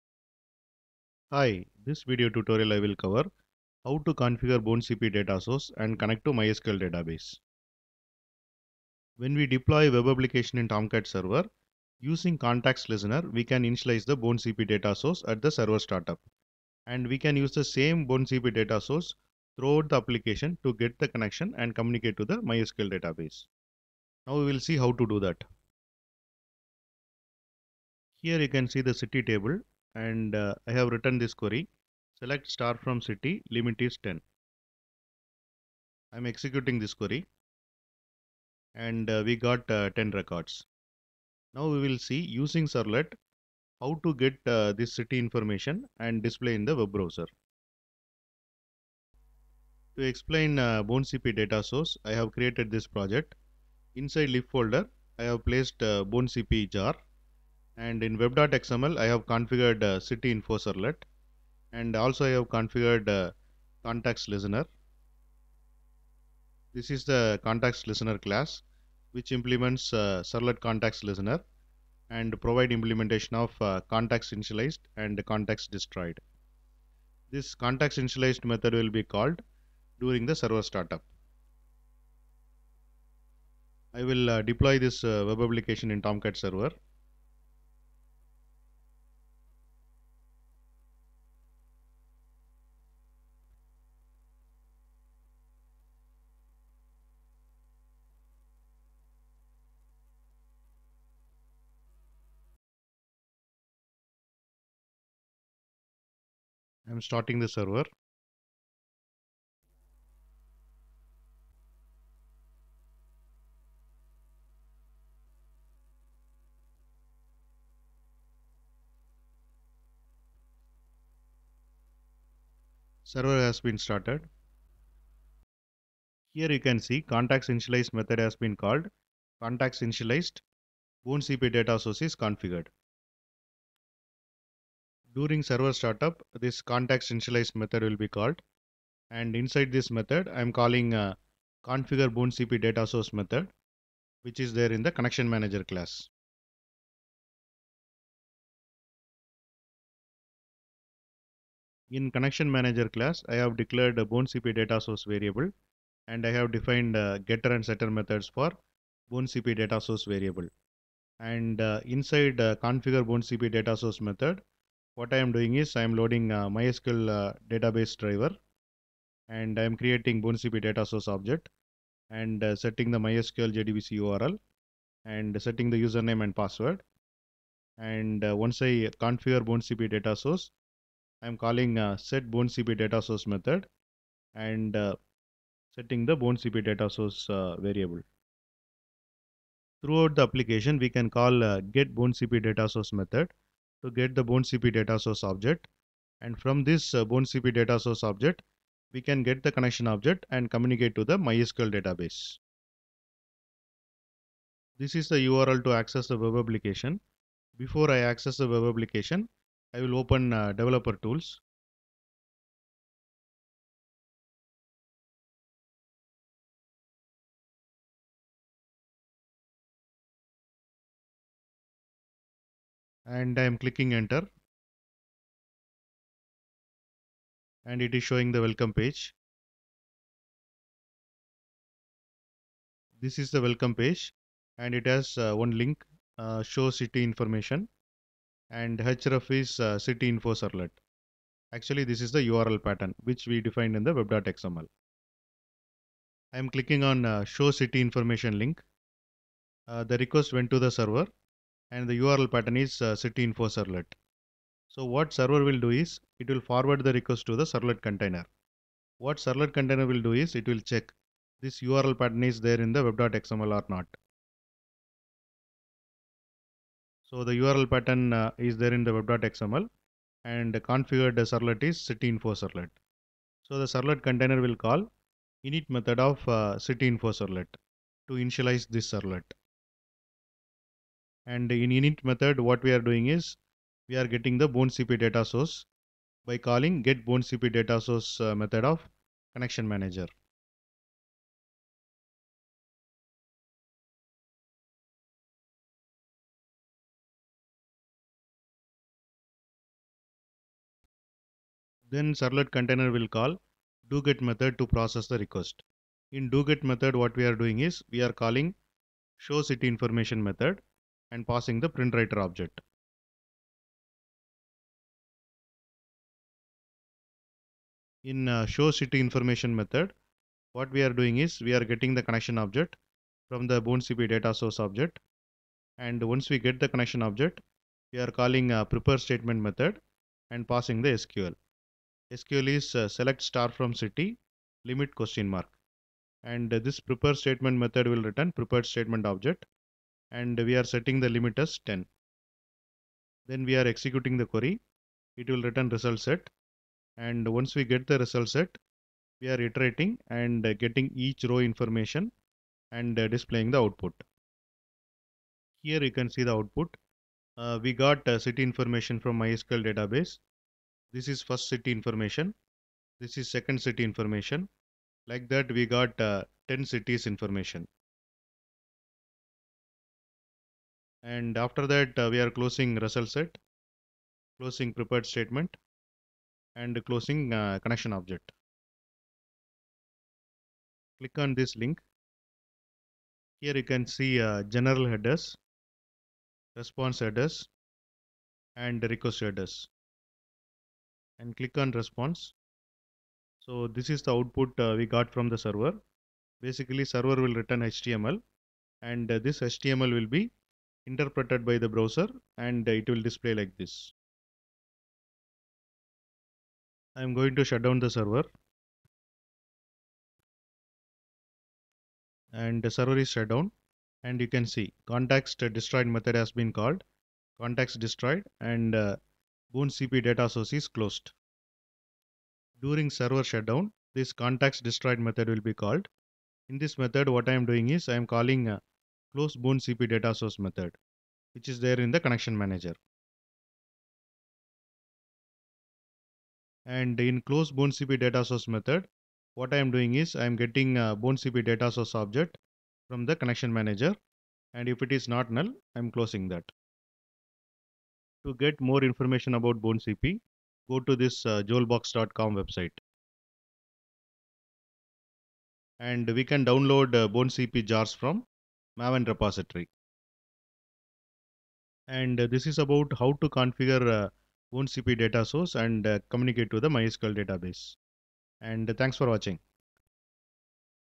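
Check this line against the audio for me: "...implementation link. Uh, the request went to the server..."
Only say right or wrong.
wrong.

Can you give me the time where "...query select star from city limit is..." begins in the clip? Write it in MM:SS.
00:31.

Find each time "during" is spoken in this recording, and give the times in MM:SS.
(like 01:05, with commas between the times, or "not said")
01:19, 02:15, 07:02.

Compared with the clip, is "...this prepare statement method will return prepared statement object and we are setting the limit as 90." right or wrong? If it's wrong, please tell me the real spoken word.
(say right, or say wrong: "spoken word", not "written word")
wrong: "10", not "90".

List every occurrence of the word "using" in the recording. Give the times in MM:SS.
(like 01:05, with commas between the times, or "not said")
00:12, 00:42.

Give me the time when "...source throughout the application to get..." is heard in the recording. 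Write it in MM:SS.
00:18.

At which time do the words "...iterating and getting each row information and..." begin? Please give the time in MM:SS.
05:49.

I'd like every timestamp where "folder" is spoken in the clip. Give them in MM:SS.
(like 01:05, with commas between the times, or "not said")
00:54.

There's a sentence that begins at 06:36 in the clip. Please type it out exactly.
Basically server will return HTML and uh, this HTML will be interpreted by the browser and it will display like this.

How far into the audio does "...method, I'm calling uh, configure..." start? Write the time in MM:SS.
02:19.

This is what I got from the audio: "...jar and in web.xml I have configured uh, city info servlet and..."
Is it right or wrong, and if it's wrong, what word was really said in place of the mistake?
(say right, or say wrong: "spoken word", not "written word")
right.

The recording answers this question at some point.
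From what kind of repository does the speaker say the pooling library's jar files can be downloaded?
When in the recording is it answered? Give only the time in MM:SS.
07:38.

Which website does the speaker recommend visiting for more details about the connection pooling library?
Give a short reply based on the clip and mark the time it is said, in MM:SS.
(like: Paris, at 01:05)
jolbox.com, at 07:31.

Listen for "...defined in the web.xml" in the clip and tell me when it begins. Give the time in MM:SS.
04:03.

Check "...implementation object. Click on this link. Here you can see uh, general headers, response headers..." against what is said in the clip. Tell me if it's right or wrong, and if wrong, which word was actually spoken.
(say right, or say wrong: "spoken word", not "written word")
wrong: "connection", not "implementation".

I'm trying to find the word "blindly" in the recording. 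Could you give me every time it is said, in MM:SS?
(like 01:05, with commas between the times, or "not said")
not said.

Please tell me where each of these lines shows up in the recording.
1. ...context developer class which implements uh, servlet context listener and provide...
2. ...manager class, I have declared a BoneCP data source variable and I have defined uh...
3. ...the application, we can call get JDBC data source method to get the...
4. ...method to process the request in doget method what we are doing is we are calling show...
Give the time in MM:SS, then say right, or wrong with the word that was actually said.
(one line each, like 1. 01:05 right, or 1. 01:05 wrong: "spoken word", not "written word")
1. 01:07 wrong: "listener", not "developer"
2. 02:32 right
3. 03:10 wrong: "BoneCP", not "JDBC"
4. 05:04 right.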